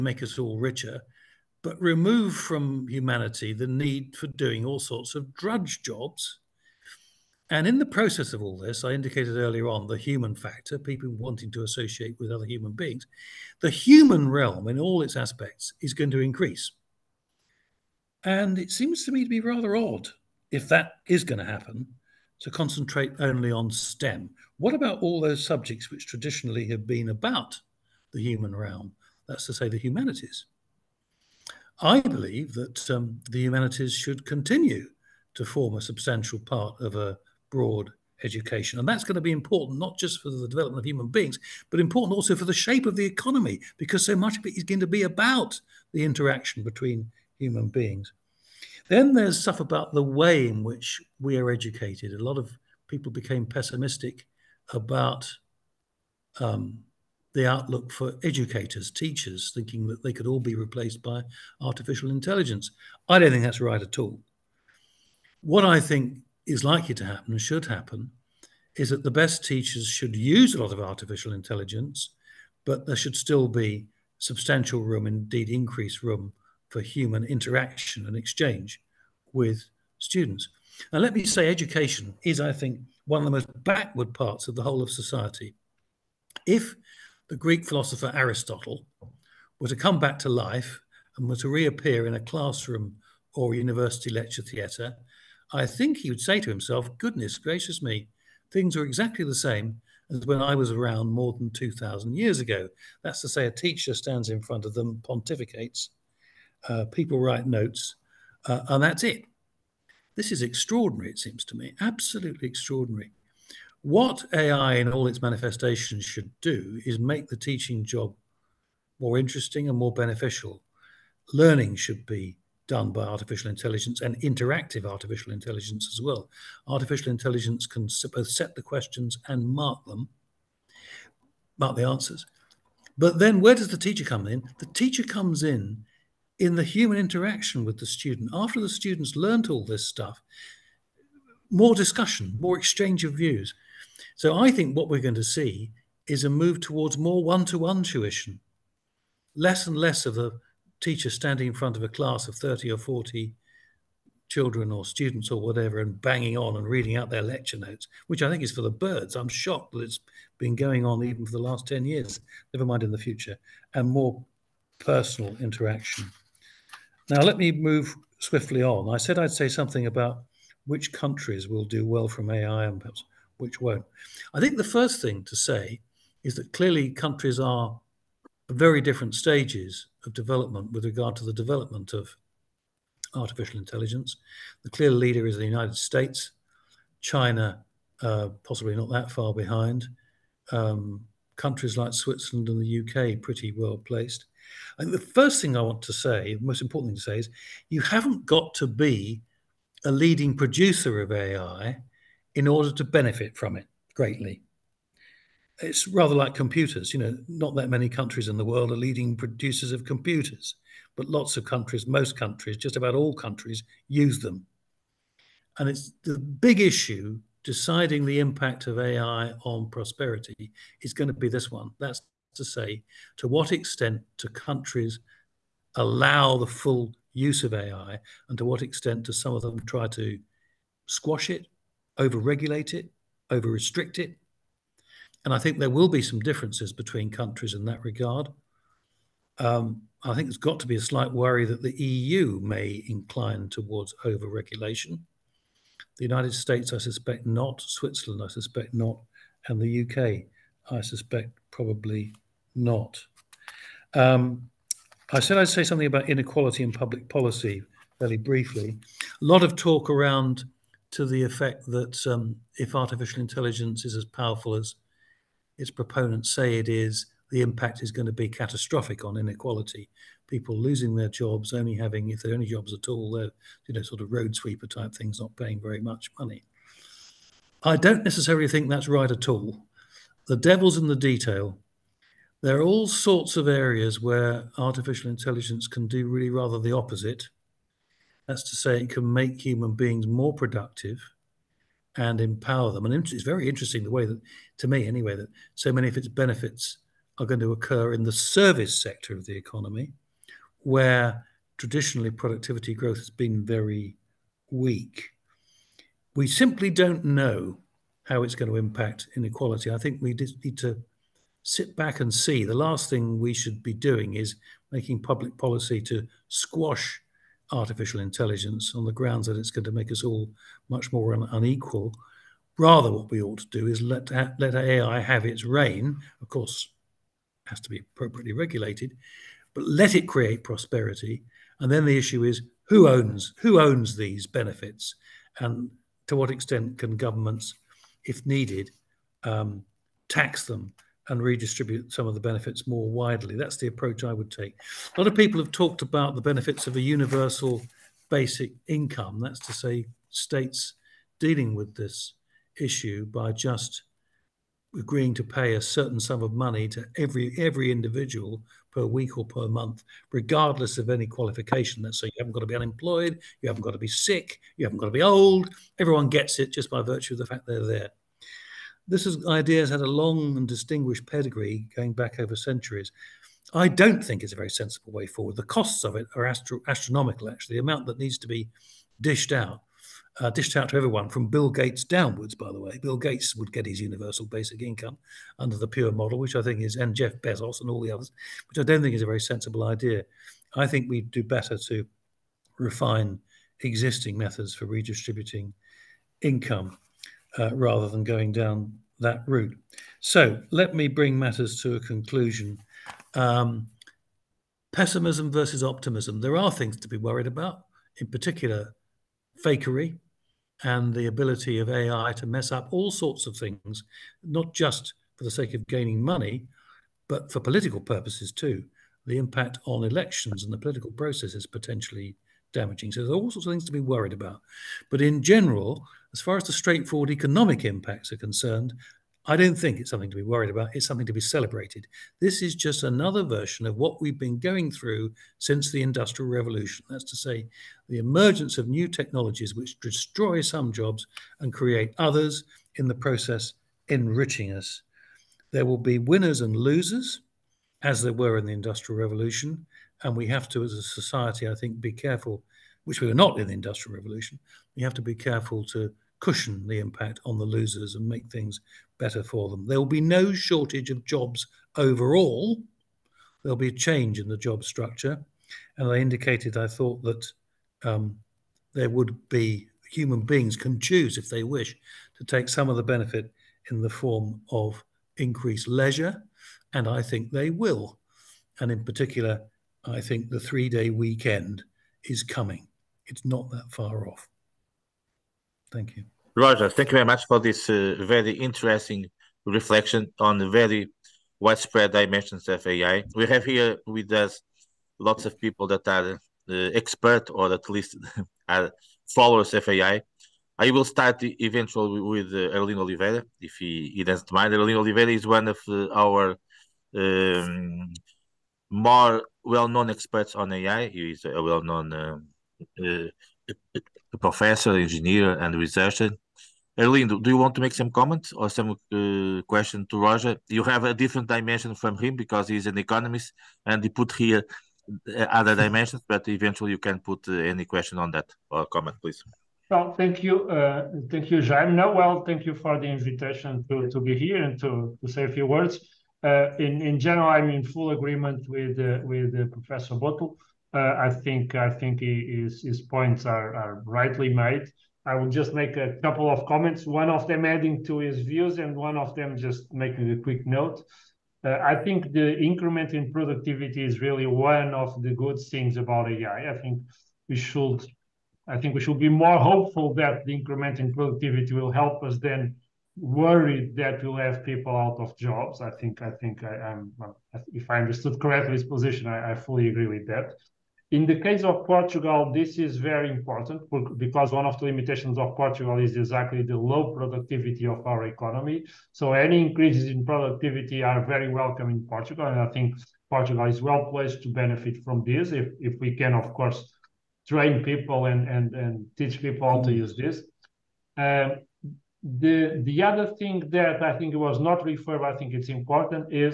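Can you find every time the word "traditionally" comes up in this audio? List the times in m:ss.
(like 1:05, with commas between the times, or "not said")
0:26, 5:01.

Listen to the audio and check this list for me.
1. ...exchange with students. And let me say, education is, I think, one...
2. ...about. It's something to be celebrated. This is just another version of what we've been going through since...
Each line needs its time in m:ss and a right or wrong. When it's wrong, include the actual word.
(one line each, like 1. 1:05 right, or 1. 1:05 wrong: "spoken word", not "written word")
1. 1:18 right
2. 7:10 right.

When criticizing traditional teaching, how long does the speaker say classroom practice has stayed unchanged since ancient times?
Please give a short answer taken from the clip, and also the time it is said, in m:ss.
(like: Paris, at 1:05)
more than 2,000 years, at 1:41.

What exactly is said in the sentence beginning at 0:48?
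Then there's stuff about the way in which we are educated.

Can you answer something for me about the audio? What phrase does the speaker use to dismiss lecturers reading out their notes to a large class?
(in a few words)
for the birds.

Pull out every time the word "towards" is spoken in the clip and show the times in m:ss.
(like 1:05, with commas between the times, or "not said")
2:26, 4:03.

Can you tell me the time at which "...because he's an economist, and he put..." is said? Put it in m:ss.
8:42.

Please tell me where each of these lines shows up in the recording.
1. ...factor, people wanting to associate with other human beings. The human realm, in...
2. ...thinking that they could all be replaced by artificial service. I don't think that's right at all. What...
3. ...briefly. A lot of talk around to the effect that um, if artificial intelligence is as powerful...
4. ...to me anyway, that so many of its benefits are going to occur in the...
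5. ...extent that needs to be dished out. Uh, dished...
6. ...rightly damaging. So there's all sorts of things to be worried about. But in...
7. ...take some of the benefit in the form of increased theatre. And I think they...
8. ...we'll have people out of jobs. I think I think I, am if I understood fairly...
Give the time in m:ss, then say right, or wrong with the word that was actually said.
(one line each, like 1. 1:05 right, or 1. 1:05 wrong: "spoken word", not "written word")
1. 0:10 right
2. 0:59 wrong: "intelligence", not "service"
3. 4:18 right
4. 4:54 right
5. 6:17 wrong: "amount", not "extent"
6. 7:01 wrong: "potentially", not "rightly"
7. 7:52 wrong: "leisure", not "theatre"
8. 9:24 wrong: "correctly", not "fairly".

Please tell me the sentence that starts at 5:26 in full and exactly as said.
Of course, has to be appropriately regulated, but let it create prosperity.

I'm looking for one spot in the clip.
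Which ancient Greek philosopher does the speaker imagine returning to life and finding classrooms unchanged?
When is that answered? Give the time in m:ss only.
1:28.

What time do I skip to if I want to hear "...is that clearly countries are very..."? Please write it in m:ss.
2:56.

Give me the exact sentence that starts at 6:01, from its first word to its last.
That's so you haven't got to be unemployed, you haven't got to be sick, you haven't got to be old.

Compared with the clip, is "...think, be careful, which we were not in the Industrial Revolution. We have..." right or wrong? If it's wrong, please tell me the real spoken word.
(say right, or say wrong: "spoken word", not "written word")
right.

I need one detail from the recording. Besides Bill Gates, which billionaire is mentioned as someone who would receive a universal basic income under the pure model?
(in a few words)
Jeff Bezos.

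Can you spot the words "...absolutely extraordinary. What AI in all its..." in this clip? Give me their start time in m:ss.
1:51.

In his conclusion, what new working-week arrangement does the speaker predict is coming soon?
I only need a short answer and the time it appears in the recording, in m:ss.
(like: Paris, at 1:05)
three day weekend, at 8:00.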